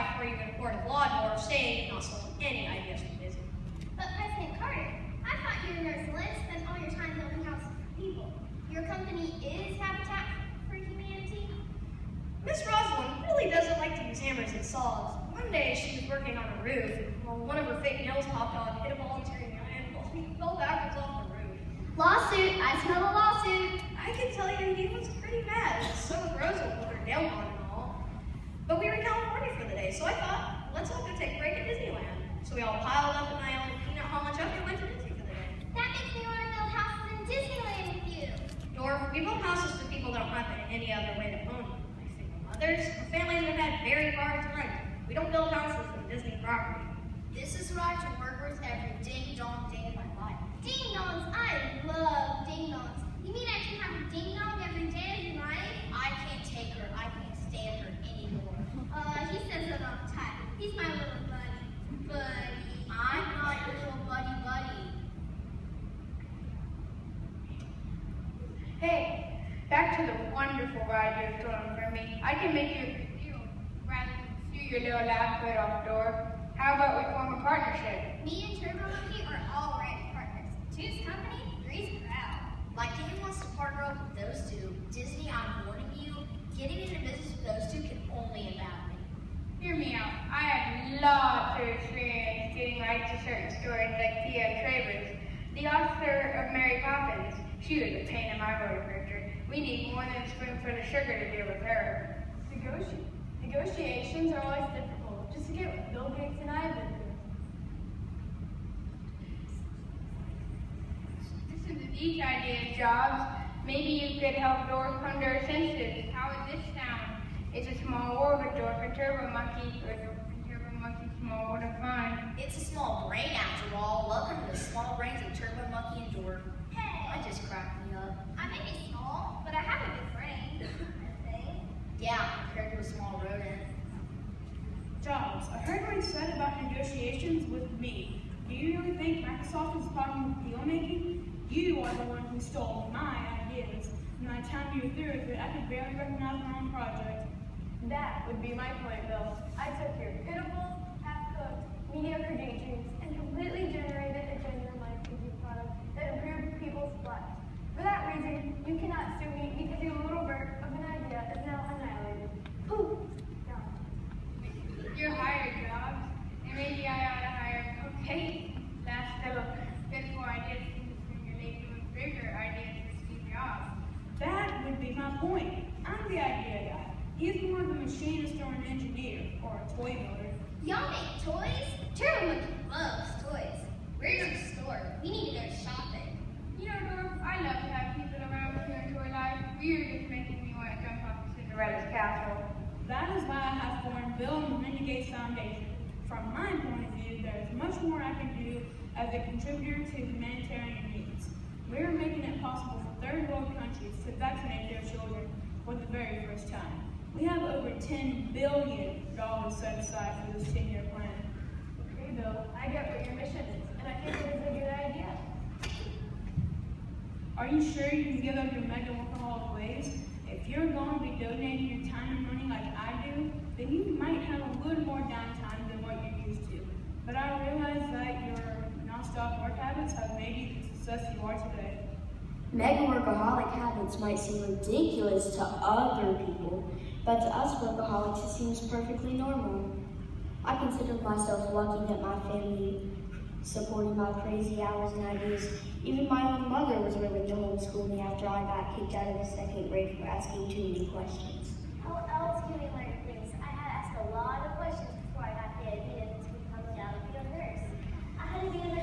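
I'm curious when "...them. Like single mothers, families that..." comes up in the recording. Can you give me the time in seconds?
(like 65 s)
41 s.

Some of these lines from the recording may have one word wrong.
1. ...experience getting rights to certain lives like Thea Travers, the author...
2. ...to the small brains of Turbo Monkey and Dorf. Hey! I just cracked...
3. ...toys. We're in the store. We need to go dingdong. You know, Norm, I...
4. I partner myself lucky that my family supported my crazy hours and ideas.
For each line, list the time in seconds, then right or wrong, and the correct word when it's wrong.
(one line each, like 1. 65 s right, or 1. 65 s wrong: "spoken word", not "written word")
1. 91 s wrong: "stories", not "lives"
2. 124 s right
3. 183 s wrong: "shopping", not "dingdong"
4. 240 s wrong: "consider", not "partner".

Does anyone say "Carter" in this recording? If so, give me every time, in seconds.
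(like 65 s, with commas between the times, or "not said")
4 s.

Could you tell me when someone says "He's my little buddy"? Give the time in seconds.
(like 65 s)
60 s.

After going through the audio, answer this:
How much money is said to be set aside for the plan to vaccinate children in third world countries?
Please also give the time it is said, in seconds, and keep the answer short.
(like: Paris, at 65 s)
$10 billion, at 207 s.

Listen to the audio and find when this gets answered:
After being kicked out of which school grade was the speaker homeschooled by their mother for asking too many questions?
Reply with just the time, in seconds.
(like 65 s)
249 s.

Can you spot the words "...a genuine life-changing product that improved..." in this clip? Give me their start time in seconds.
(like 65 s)
154 s.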